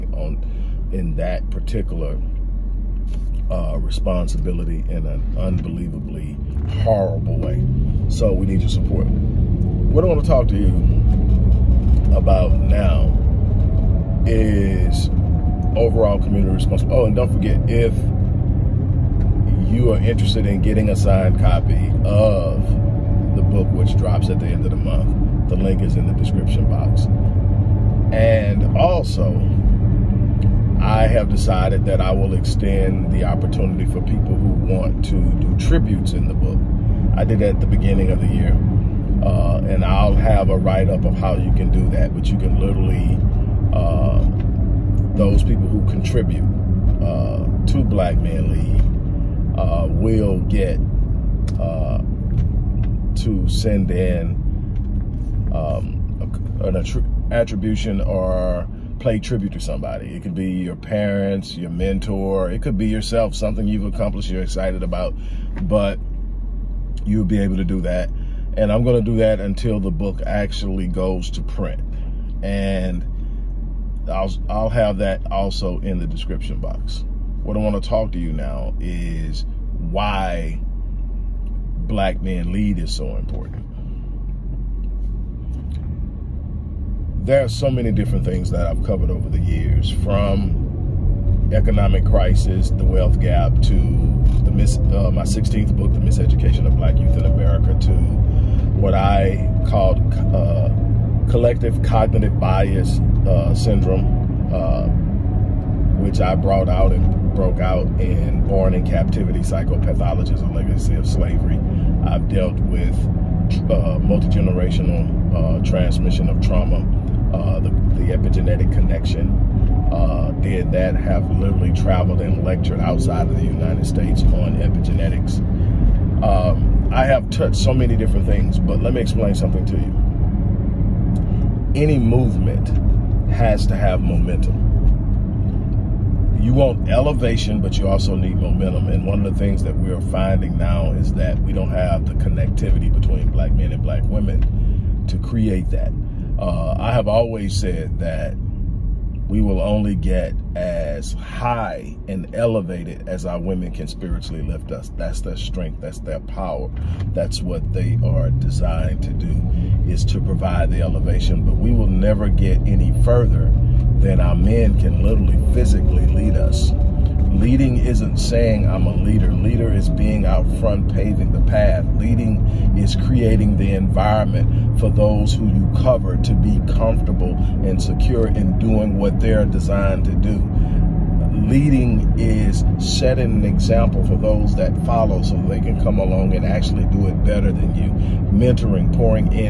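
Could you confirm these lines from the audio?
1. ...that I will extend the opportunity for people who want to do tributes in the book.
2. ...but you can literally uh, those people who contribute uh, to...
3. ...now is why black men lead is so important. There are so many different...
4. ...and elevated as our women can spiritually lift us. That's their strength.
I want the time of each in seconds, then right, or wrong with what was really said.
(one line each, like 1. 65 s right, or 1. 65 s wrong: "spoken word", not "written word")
1. 31 s right
2. 42 s right
3. 78 s right
4. 152 s right.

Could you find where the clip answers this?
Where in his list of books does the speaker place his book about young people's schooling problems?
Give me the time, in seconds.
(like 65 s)
95 s.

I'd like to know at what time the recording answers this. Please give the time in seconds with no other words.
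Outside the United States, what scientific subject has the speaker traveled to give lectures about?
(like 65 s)
124 s.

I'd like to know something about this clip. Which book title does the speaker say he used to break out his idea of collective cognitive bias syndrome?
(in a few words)
Born in Captivity.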